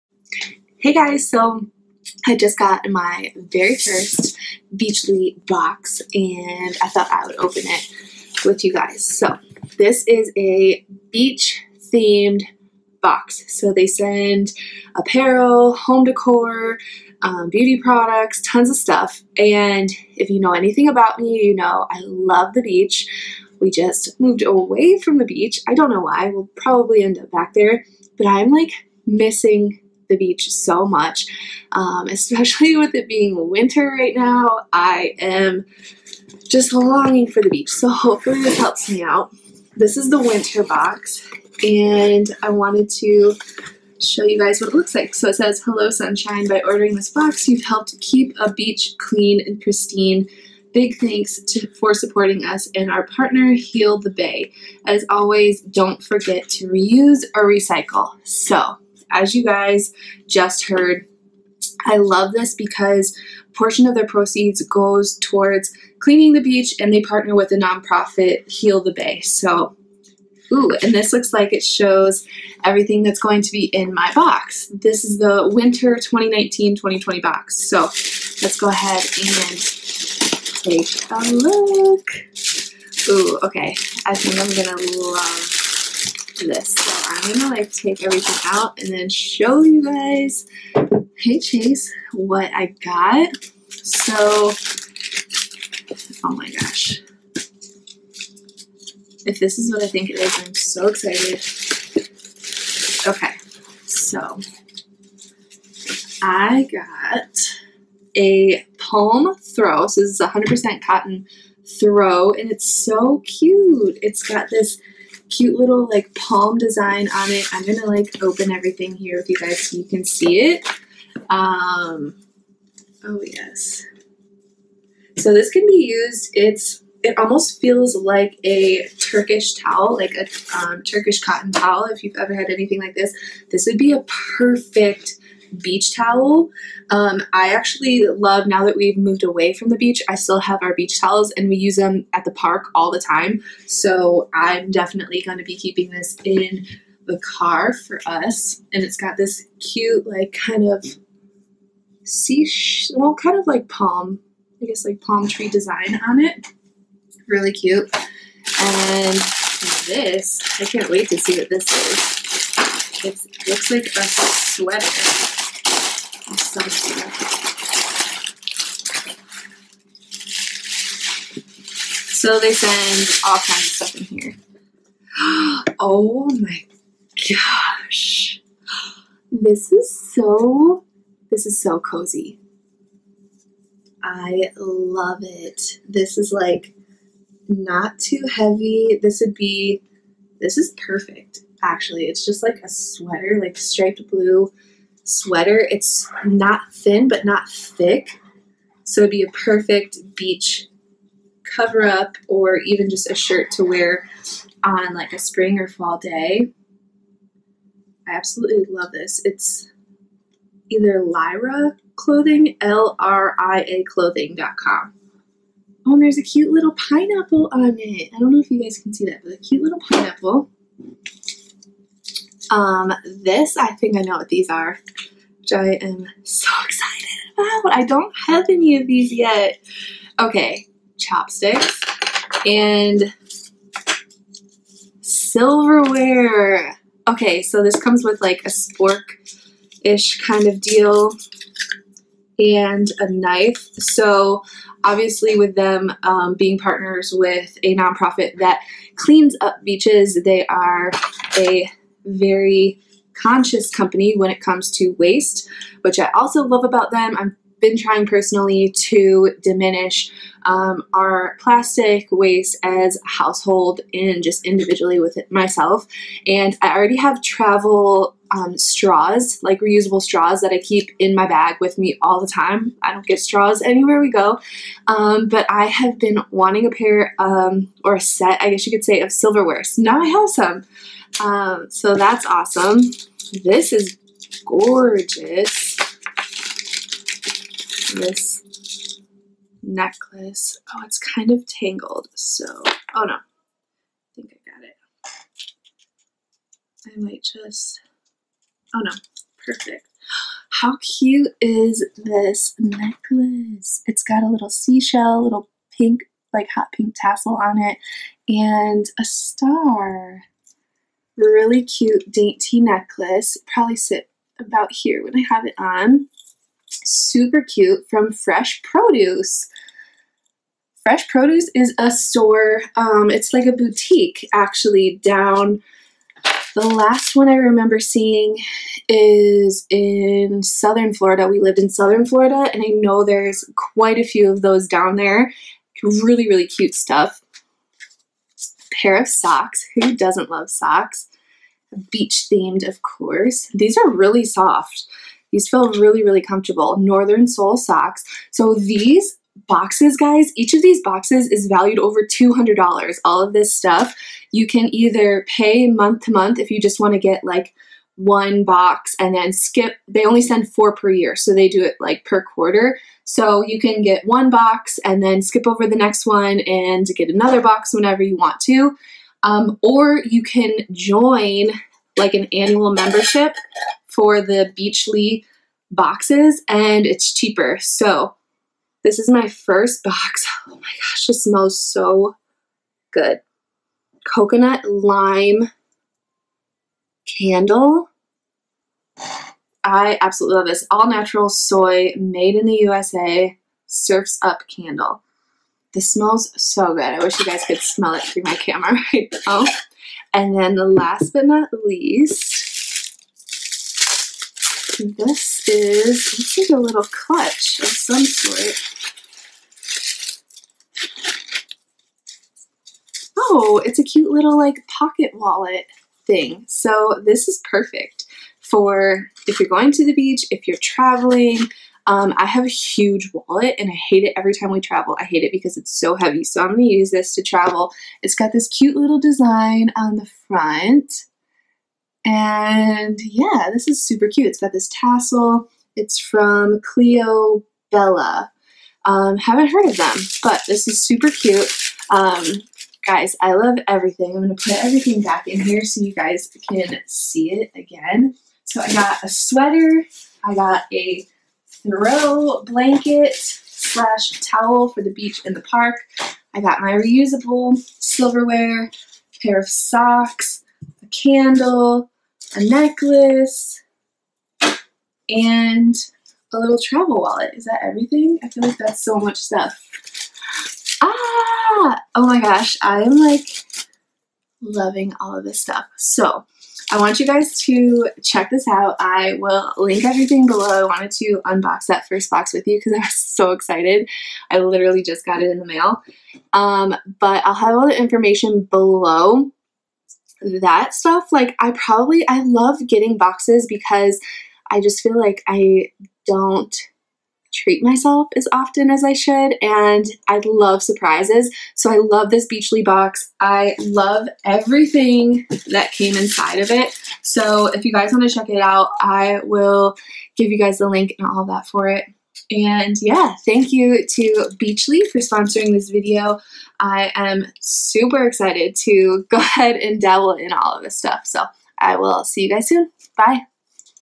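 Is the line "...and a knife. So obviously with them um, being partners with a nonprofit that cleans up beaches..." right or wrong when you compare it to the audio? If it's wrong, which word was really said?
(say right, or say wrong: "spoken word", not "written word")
right.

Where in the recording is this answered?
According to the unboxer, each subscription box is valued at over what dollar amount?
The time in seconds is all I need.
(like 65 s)
352 s.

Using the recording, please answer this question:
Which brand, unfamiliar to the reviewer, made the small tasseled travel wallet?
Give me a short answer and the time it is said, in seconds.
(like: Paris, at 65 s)
Cleo Bella, at 436 s.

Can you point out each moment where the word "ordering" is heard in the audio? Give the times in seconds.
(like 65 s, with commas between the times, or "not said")
46 s.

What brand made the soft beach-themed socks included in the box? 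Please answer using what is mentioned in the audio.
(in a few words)
Northern Soul.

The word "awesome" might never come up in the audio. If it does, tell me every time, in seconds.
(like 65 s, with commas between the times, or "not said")
282 s.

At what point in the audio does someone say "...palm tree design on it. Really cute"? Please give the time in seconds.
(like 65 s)
155 s.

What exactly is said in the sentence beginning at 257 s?
I'm been trying personally to diminish um, our plastic waste as household and just individually with it myself.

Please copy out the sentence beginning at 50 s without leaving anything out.
Big thanks to, for supporting us and our partner, Heal the Bay.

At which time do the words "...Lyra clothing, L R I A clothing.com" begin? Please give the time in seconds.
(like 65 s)
211 s.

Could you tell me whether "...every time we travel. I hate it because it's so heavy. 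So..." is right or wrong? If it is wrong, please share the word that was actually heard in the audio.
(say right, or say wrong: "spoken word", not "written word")
right.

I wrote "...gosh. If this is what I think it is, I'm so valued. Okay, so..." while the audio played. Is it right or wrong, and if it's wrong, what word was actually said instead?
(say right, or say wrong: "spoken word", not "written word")
wrong: "excited", not "valued".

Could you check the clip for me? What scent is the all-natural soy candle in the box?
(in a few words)
coconut lime.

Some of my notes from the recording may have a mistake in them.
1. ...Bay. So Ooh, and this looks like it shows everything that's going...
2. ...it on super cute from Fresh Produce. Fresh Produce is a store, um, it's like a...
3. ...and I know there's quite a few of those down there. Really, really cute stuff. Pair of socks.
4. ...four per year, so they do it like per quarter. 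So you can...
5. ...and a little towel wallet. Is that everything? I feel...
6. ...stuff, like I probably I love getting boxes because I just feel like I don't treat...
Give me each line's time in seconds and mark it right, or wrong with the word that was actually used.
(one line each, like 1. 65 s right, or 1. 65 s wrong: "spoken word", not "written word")
1. 68 s right
2. 315 s right
3. 332 s right
4. 360 s right
5. 465 s wrong: "travel", not "towel"
6. 490 s right.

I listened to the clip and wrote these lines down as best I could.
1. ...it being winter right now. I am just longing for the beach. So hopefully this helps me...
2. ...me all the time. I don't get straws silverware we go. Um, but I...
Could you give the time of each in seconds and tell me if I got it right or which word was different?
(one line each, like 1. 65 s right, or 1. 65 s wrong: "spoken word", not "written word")
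1. 32 s right
2. 271 s wrong: "anywhere", not "silverware".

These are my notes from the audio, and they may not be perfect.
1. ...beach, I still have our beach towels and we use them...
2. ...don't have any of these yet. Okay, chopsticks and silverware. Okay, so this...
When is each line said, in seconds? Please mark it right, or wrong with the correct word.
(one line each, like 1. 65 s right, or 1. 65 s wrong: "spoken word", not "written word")
1. 139 s right
2. 227 s right.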